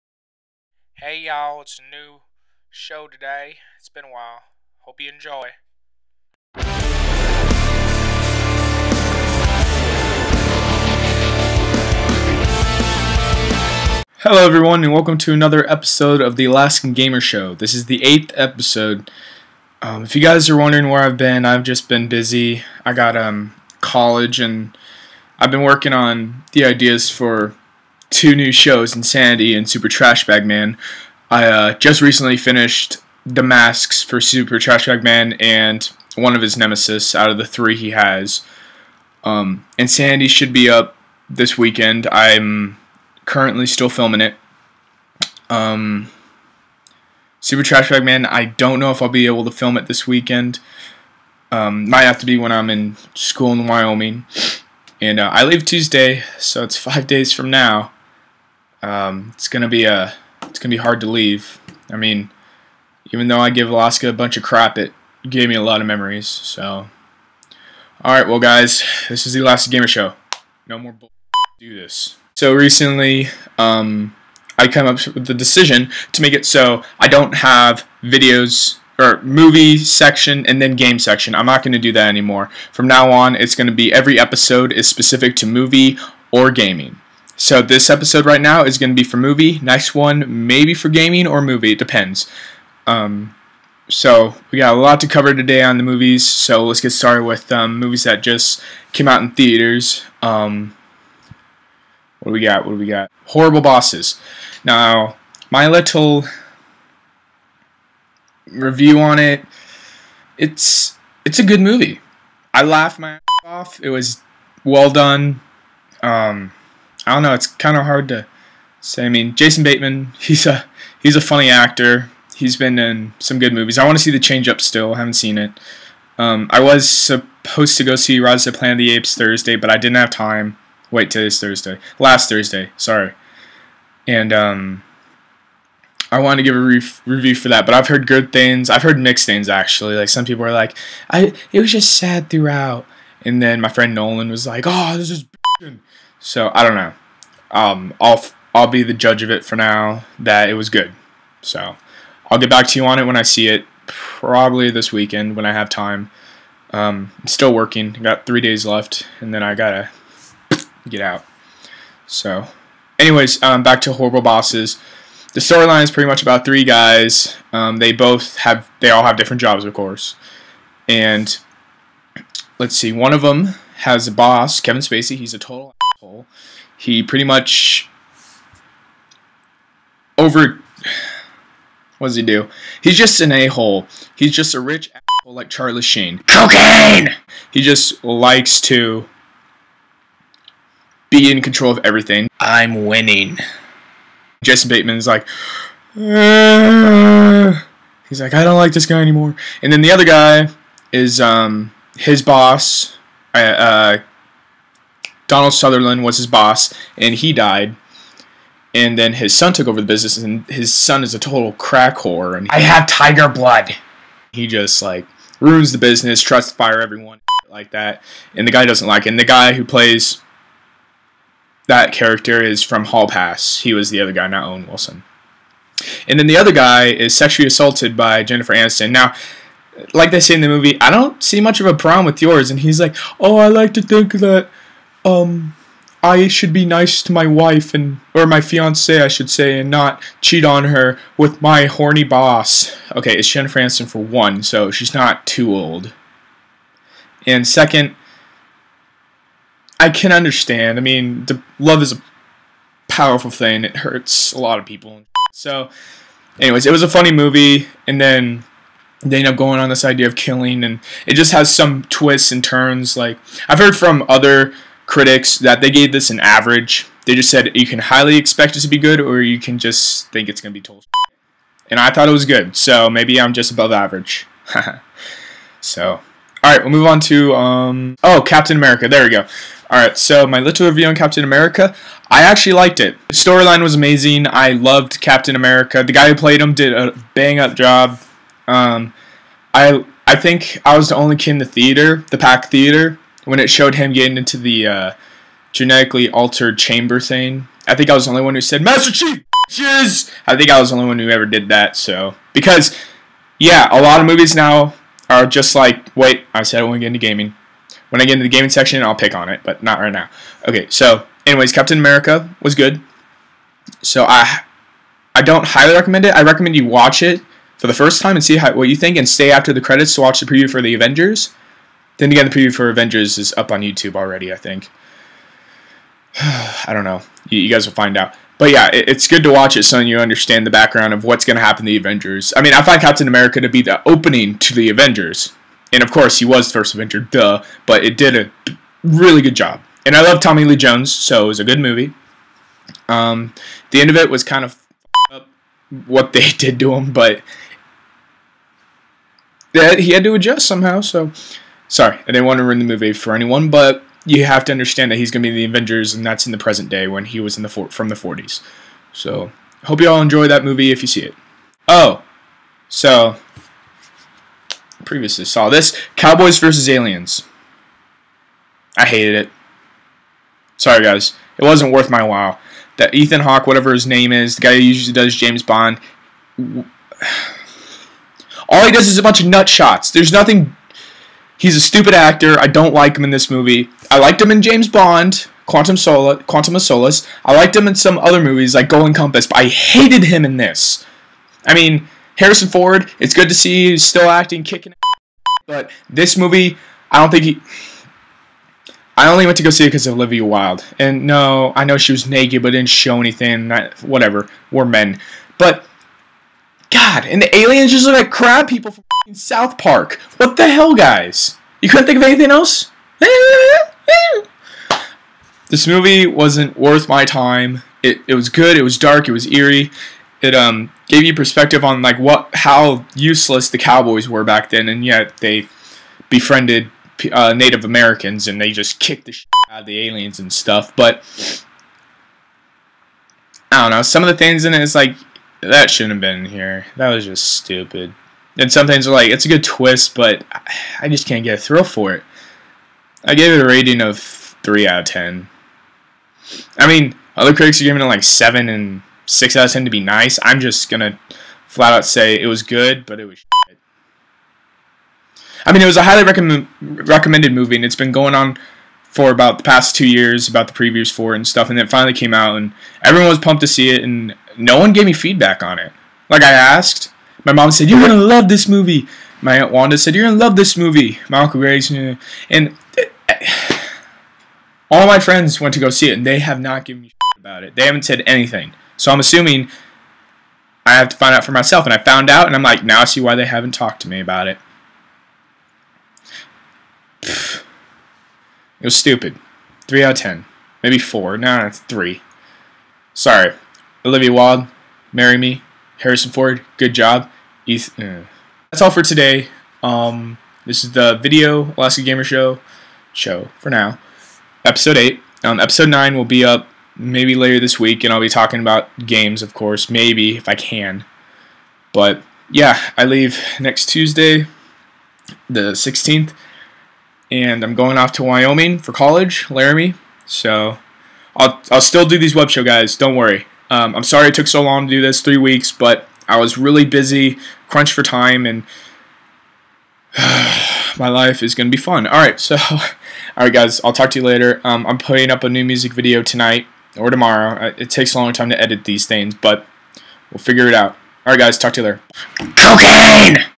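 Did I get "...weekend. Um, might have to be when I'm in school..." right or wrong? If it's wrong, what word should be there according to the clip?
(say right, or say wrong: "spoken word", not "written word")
right.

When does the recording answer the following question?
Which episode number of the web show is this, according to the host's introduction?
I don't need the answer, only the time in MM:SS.
00:18.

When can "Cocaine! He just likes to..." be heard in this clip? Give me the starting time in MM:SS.
03:06.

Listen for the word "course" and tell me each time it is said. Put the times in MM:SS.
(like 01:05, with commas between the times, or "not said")
02:49, 05:35, 08:29.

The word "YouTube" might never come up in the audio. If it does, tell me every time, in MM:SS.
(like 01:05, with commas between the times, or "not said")
05:23.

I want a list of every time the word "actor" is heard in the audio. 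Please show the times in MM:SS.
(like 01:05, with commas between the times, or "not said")
02:01, 06:21.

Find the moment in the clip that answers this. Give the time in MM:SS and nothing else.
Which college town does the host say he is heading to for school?
08:39.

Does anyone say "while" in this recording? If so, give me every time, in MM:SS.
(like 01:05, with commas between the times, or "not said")
00:04, 06:12.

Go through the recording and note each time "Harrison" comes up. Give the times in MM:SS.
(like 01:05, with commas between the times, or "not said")
06:32, 08:15.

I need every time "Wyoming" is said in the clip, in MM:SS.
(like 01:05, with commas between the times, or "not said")
00:53, 08:38.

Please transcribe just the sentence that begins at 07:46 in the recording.
Like, I asked, my mom said, You're going to love this movie.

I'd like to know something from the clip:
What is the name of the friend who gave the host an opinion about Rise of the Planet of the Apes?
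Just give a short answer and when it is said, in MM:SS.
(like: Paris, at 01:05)
Nolan, at 02:23.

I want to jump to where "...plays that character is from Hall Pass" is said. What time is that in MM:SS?
03:39.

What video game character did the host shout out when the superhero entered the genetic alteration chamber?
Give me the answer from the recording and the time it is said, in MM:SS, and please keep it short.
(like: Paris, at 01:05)
Master Chief, at 04:58.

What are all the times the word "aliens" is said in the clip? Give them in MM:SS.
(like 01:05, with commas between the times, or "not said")
06:06, 06:47, 07:09.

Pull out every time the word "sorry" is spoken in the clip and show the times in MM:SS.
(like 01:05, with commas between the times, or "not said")
02:12, 05:51, 06:10, 08:12, 08:43.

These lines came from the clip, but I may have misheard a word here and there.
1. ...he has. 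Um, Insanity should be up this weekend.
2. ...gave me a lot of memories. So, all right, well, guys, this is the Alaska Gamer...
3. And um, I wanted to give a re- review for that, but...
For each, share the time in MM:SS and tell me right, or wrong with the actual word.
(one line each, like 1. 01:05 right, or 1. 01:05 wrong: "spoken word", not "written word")
1. 00:37 right
2. 01:05 right
3. 02:14 right.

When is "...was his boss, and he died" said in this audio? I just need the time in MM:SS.
03:26.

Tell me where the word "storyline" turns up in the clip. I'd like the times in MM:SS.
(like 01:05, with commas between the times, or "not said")
02:45, 04:43.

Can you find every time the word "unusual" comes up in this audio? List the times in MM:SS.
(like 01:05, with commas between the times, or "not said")
not said.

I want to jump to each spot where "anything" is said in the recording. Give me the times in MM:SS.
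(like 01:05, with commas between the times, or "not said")
06:42, 06:52, 07:58.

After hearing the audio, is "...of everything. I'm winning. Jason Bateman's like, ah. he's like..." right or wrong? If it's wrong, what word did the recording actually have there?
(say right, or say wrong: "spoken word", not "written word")
right.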